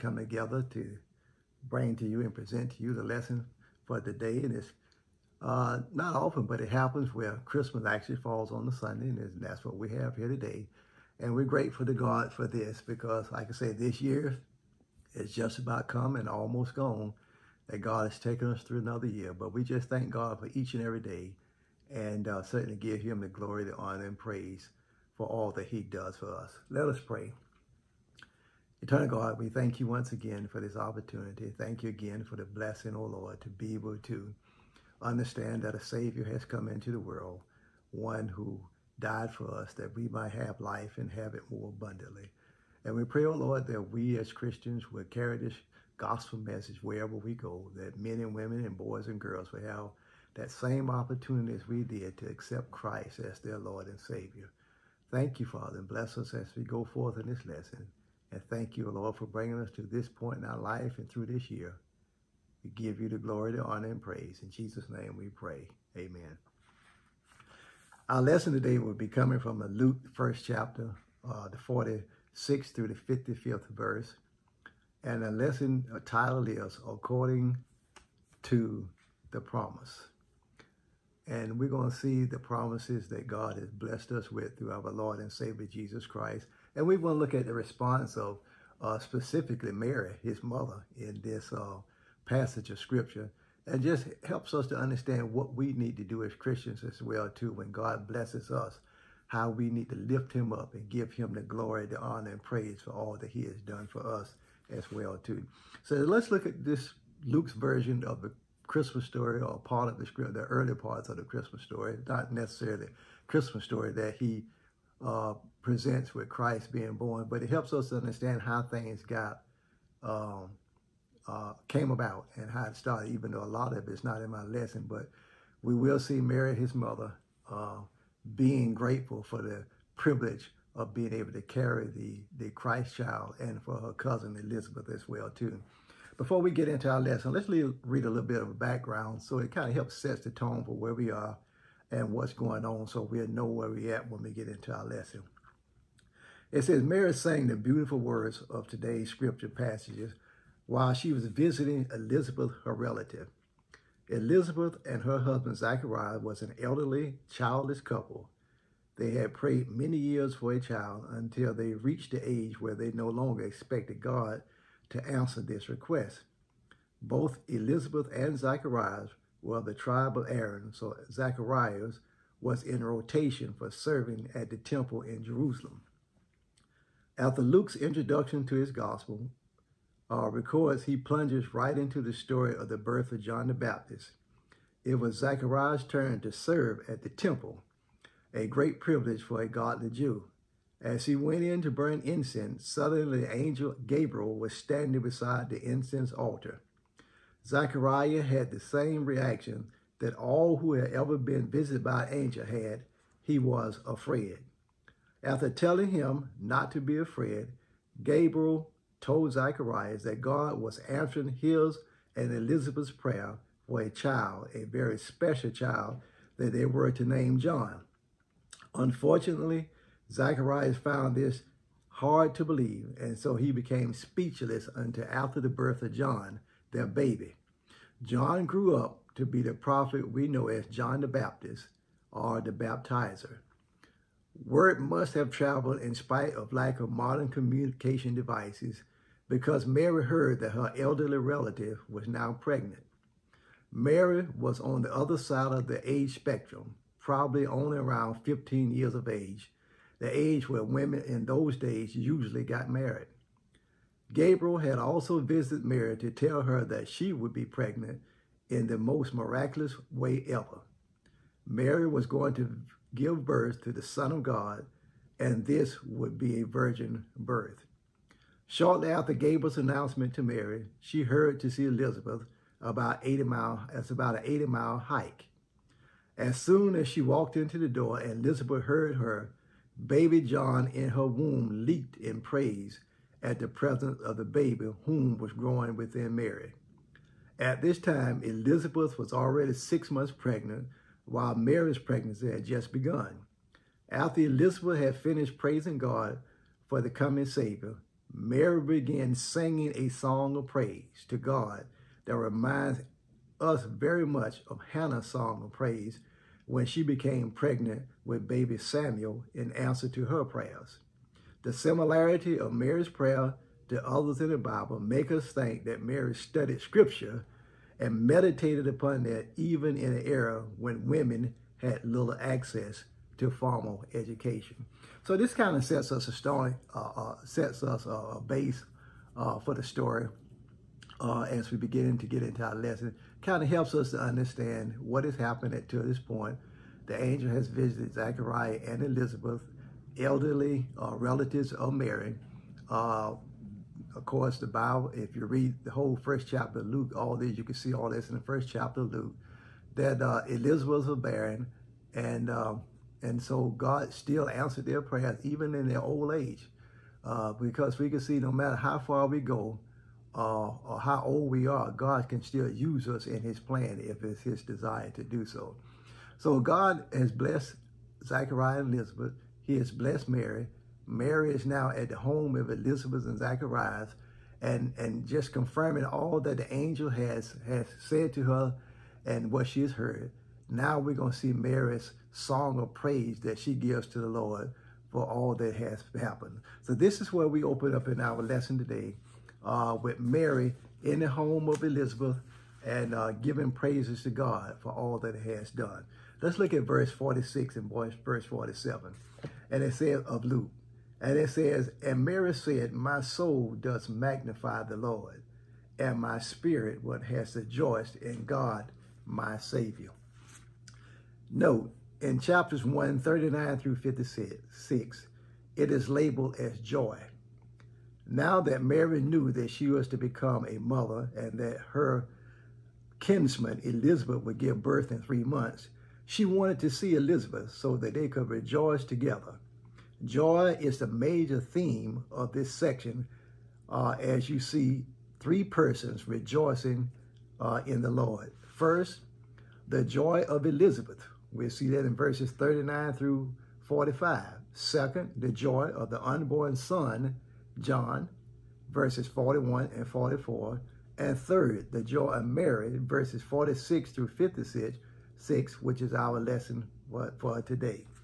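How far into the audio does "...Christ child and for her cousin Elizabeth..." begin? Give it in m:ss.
2:12.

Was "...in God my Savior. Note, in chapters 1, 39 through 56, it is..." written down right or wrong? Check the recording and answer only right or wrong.
right.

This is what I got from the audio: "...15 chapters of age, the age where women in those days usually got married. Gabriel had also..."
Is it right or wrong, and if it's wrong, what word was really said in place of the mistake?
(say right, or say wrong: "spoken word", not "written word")
wrong: "years", not "chapters".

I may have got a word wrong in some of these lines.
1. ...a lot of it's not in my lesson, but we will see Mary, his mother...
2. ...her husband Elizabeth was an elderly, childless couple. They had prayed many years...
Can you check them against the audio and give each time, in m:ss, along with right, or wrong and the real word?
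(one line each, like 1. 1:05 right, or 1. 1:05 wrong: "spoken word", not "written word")
1. 2:03 right
2. 2:35 wrong: "Zachariah", not "Elizabeth".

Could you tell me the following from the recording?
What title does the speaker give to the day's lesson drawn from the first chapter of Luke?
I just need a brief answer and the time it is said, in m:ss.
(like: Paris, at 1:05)
According to the Promise, at 1:16.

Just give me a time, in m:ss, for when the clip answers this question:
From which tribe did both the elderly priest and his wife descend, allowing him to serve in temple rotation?
2:49.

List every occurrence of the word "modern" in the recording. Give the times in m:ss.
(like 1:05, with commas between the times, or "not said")
3:56.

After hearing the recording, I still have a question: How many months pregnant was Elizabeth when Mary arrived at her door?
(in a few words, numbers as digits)
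6.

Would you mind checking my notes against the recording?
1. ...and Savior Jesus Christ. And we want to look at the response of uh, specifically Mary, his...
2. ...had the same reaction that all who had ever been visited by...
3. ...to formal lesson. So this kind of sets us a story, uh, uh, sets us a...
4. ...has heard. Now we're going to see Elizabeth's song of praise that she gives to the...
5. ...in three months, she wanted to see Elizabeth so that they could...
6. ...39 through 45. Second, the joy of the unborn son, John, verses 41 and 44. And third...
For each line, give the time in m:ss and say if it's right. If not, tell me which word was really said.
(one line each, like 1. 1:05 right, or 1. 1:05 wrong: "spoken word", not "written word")
1. 1:25 right
2. 3:18 right
3. 5:23 wrong: "education", not "lesson"
4. 6:19 wrong: "Mary", not "Elizabeth"
5. 7:04 right
6. 7:22 right.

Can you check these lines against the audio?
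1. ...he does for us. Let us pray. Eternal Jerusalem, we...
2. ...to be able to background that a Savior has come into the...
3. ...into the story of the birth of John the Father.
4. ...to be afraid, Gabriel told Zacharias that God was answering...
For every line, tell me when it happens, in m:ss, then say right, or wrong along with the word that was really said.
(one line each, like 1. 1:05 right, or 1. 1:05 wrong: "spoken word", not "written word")
1. 0:25 wrong: "God", not "Jerusalem"
2. 0:33 wrong: "understand", not "background"
3. 3:01 wrong: "Baptist", not "Father"
4. 3:26 right.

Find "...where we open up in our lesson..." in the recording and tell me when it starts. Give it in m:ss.
6:27.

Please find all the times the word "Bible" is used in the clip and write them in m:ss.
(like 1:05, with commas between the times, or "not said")
5:14, 5:44.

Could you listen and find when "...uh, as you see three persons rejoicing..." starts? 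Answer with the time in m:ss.
7:13.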